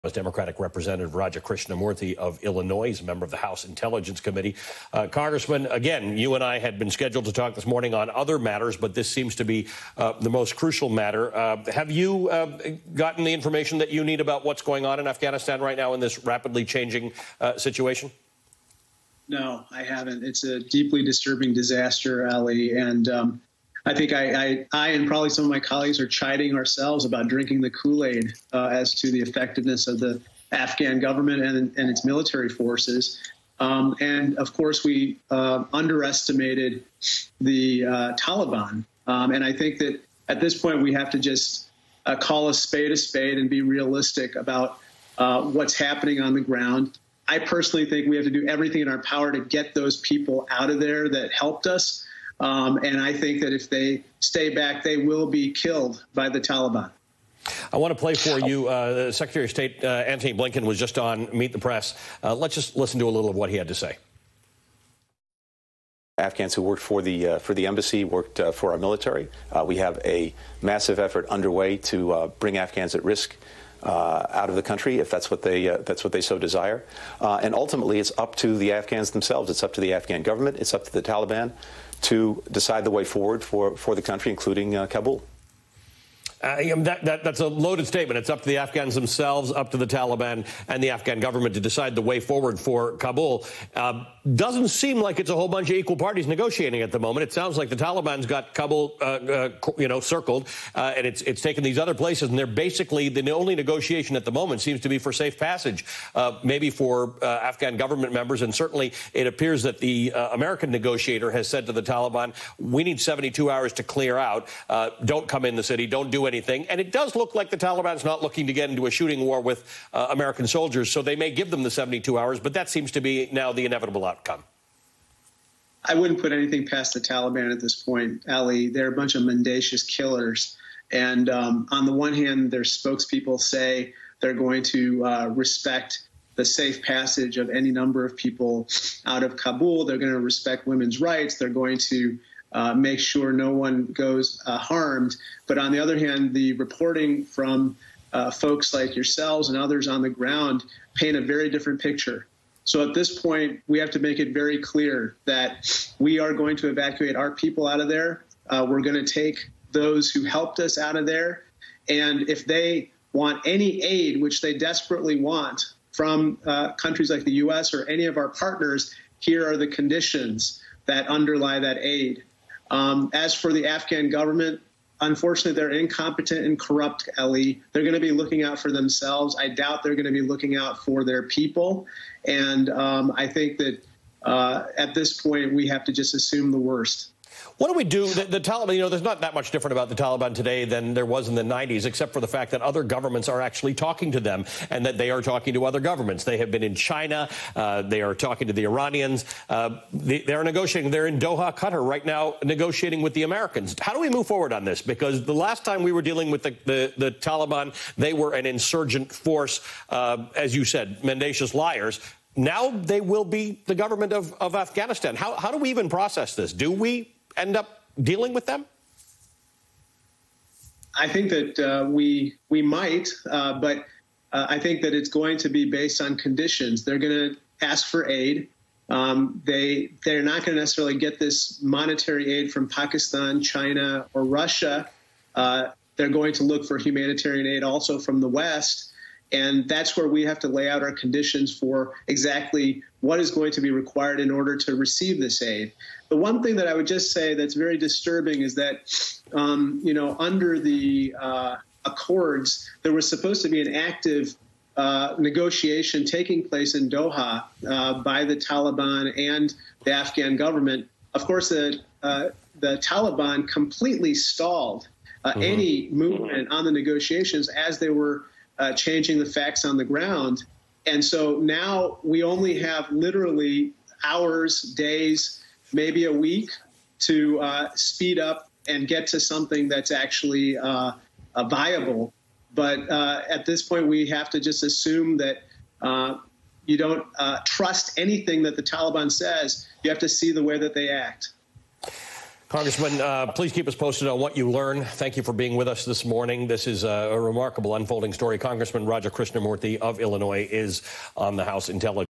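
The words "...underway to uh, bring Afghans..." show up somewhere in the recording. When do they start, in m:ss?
1:11.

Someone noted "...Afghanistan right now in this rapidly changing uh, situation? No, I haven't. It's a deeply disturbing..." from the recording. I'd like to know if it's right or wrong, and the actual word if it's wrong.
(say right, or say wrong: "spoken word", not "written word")
right.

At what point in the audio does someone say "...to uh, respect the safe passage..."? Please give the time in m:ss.
2:14.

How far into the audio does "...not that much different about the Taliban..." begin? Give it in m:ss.
3:09.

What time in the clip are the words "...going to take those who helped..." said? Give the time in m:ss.
2:38.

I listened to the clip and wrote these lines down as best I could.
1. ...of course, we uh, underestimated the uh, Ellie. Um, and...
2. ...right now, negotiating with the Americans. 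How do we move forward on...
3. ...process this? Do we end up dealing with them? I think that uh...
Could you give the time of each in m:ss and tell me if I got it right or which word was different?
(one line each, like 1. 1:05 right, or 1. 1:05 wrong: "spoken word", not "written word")
1. 0:34 wrong: "Taliban", not "Ellie"
2. 3:21 right
3. 3:35 right.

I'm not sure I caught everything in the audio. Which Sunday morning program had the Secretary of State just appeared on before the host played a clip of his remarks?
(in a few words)
Meet the Press.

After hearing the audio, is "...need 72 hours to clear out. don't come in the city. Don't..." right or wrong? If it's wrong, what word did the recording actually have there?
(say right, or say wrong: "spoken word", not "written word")
right.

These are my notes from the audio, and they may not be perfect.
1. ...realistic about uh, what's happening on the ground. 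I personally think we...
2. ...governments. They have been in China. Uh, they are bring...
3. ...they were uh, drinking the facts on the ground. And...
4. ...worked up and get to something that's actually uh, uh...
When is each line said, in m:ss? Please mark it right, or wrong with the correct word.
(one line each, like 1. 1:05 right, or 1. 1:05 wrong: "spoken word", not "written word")
1. 0:43 right
2. 3:15 wrong: "talking", not "bring"
3. 4:27 wrong: "changing", not "drinking"
4. 4:37 wrong: "speed", not "worked".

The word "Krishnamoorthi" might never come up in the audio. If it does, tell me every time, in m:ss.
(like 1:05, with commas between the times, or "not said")
0:01, 4:59.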